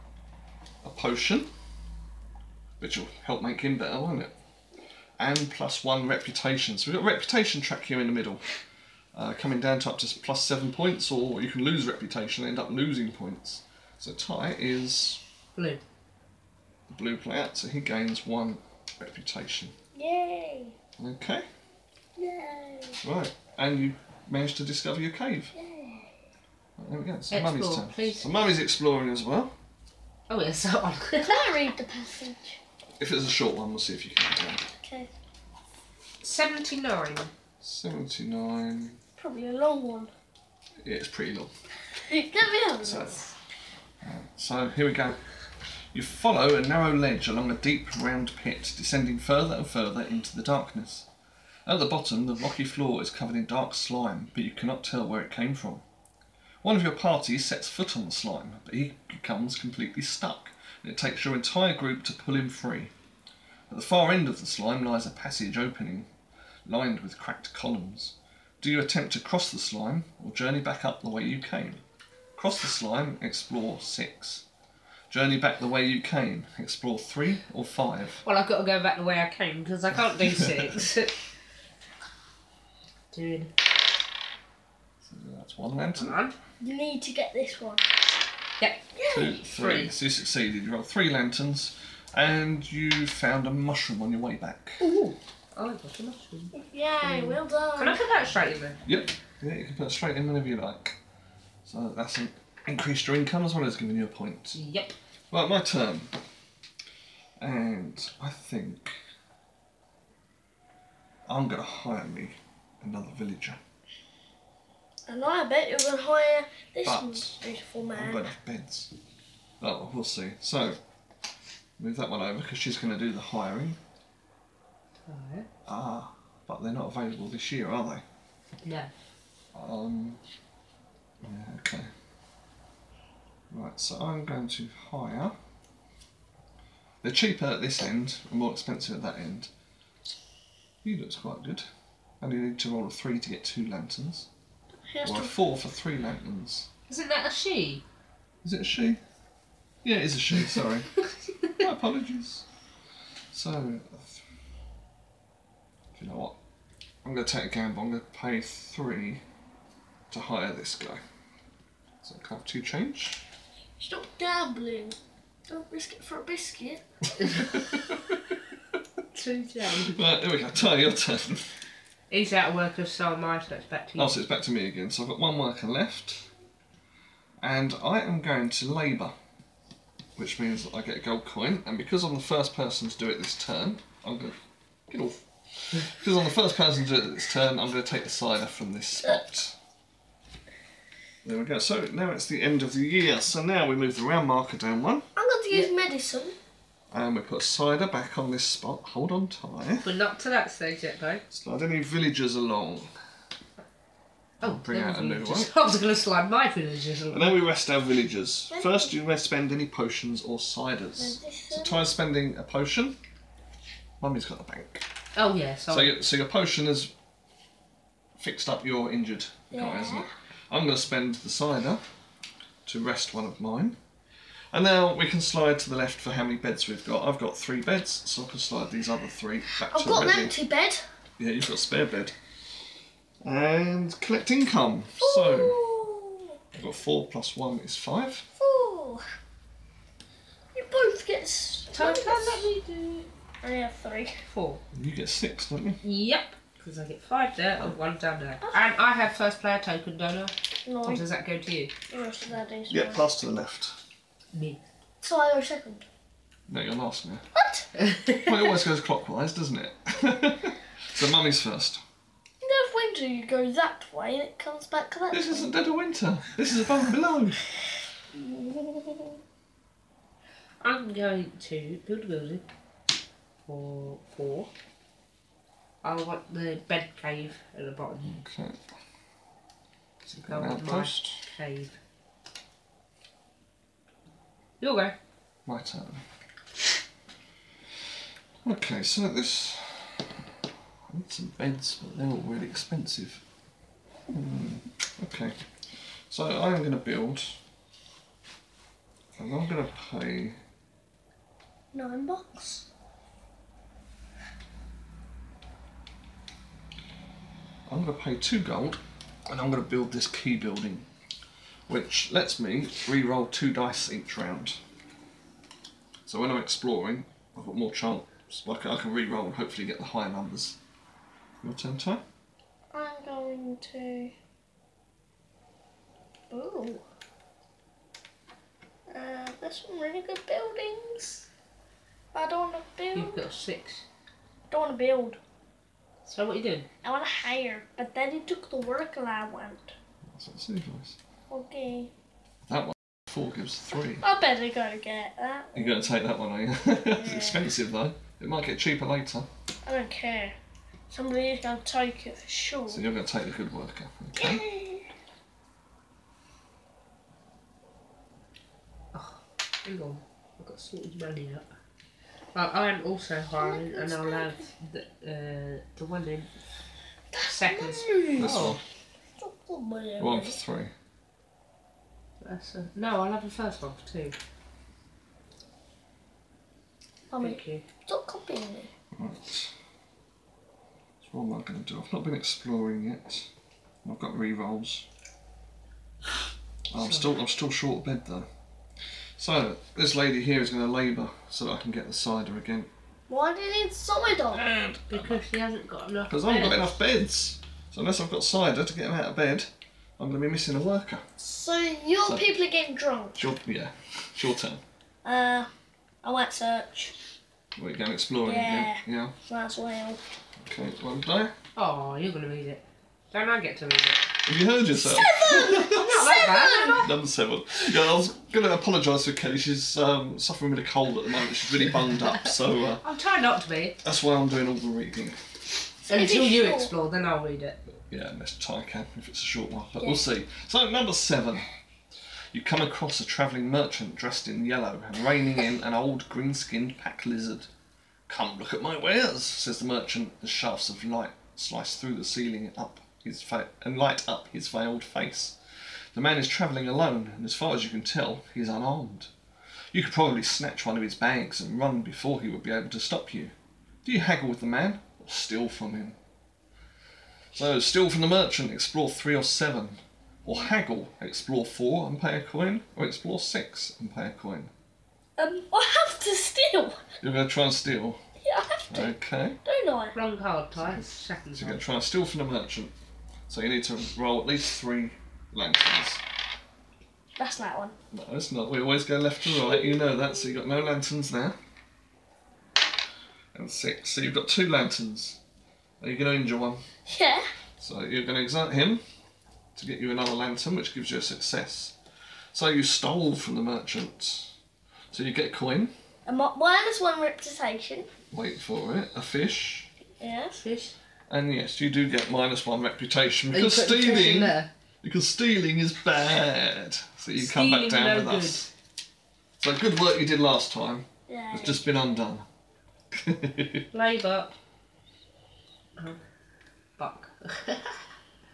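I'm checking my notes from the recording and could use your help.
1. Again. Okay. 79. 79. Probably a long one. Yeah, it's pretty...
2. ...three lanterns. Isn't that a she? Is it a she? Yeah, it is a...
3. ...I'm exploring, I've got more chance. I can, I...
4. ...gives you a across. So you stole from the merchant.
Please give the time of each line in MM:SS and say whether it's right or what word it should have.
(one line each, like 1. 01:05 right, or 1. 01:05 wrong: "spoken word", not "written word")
1. 00:34 right
2. 02:25 right
3. 05:16 right
4. 08:10 wrong: "success", not "across".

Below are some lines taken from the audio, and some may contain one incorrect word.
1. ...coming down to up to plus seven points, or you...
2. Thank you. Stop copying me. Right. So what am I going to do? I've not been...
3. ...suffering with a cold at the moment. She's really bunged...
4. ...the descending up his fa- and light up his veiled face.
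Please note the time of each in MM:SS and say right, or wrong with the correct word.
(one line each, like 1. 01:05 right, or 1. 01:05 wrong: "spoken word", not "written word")
1. 00:09 right
2. 06:17 right
3. 07:00 right
4. 07:21 wrong: "ceiling", not "descending".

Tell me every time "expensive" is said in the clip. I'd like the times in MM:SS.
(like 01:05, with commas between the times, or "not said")
02:18, 04:52, 05:47.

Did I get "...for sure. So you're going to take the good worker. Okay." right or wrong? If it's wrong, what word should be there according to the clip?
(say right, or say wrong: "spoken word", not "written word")
right.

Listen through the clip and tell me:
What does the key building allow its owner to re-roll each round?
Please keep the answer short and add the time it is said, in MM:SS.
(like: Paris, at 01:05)
two dice, at 05:13.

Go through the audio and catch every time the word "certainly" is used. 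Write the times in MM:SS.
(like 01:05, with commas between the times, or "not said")
not said.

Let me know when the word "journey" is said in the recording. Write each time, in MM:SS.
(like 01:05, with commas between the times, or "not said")
01:10, 01:15.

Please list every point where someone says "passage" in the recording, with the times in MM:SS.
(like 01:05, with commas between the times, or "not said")
00:31, 01:05.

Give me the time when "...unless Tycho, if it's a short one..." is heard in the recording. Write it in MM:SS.
07:08.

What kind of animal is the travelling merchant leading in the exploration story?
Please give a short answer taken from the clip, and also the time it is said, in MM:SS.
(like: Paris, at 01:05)
pack lizard, at 07:16.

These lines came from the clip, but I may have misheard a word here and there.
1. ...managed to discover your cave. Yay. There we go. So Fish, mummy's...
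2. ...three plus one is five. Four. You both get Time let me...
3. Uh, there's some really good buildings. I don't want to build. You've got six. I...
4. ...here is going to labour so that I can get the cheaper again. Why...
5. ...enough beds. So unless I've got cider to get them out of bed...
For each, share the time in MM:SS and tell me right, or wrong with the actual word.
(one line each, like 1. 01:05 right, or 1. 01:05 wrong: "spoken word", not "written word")
1. 00:24 wrong: "Explore", not "Fish"
2. 03:56 wrong: "four", not "three"
3. 05:28 right
4. 06:30 wrong: "cider", not "cheaper"
5. 06:36 right.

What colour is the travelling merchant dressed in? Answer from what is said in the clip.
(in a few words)
yellow.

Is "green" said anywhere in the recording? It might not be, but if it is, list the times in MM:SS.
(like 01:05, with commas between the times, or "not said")
07:16.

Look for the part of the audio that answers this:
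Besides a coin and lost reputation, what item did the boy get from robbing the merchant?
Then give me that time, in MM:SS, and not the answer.
08:18.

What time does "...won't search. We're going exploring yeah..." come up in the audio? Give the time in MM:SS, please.
06:46.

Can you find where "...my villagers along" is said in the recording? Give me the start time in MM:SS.
03:26.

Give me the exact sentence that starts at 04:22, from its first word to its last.
In dead of winter you go that way and it comes back that This way.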